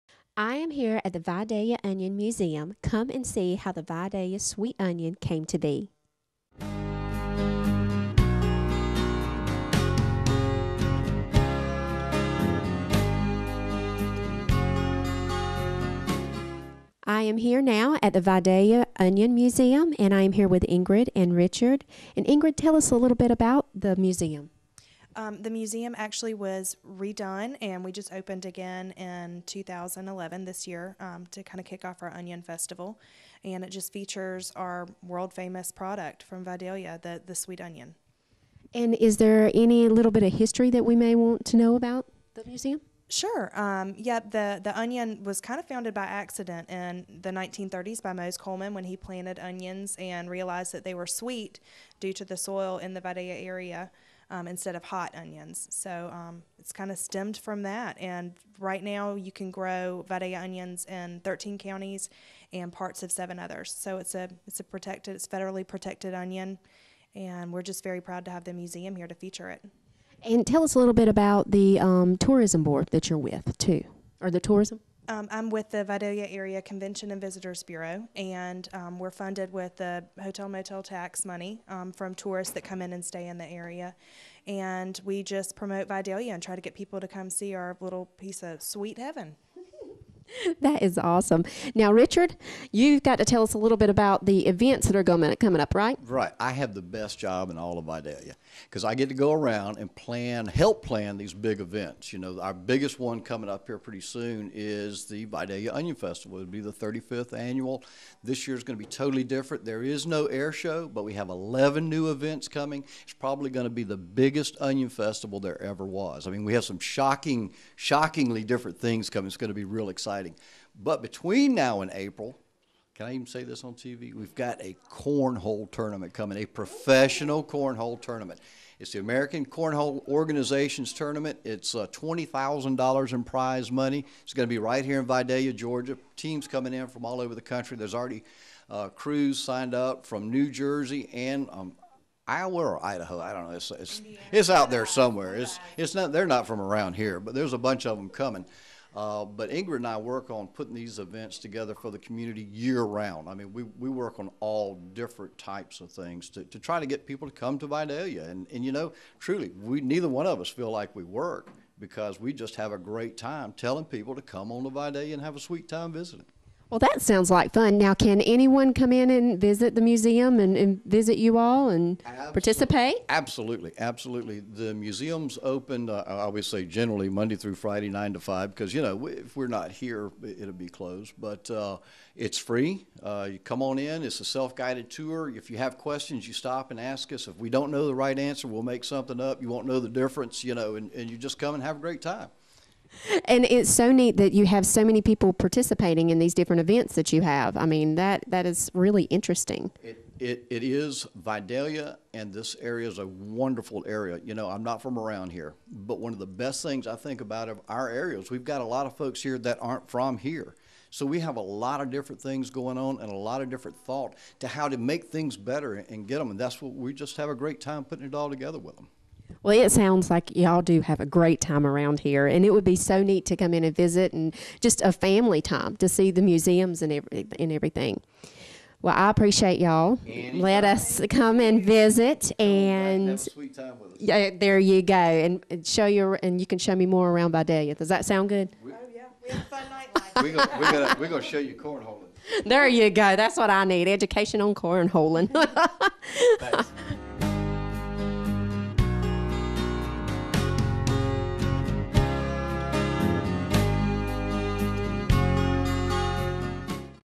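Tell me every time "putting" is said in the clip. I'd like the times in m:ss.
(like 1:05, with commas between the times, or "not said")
2:30, 3:37.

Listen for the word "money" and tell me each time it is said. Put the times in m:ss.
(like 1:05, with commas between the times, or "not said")
1:21, 2:13.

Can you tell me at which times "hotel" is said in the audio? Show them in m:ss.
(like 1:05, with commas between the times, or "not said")
1:20.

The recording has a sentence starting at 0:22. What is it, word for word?
And Ingrid, tell us a little bit about the museum.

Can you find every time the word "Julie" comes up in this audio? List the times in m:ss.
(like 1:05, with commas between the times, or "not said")
not said.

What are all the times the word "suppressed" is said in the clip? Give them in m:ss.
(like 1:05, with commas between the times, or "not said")
not said.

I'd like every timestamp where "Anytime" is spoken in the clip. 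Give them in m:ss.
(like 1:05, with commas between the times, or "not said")
3:50.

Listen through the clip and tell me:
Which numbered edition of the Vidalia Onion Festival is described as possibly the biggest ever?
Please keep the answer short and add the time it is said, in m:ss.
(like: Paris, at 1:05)
35th, at 1:46.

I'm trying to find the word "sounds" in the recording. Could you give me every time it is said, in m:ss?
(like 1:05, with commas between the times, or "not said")
2:47, 3:39, 3:58.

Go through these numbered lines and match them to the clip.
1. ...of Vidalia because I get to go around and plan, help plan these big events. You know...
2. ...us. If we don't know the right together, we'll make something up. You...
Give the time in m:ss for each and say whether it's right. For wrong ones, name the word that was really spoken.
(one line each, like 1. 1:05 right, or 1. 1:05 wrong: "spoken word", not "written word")
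1. 1:37 right
2. 3:07 wrong: "answer", not "together".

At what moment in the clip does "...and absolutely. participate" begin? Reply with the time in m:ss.
2:51.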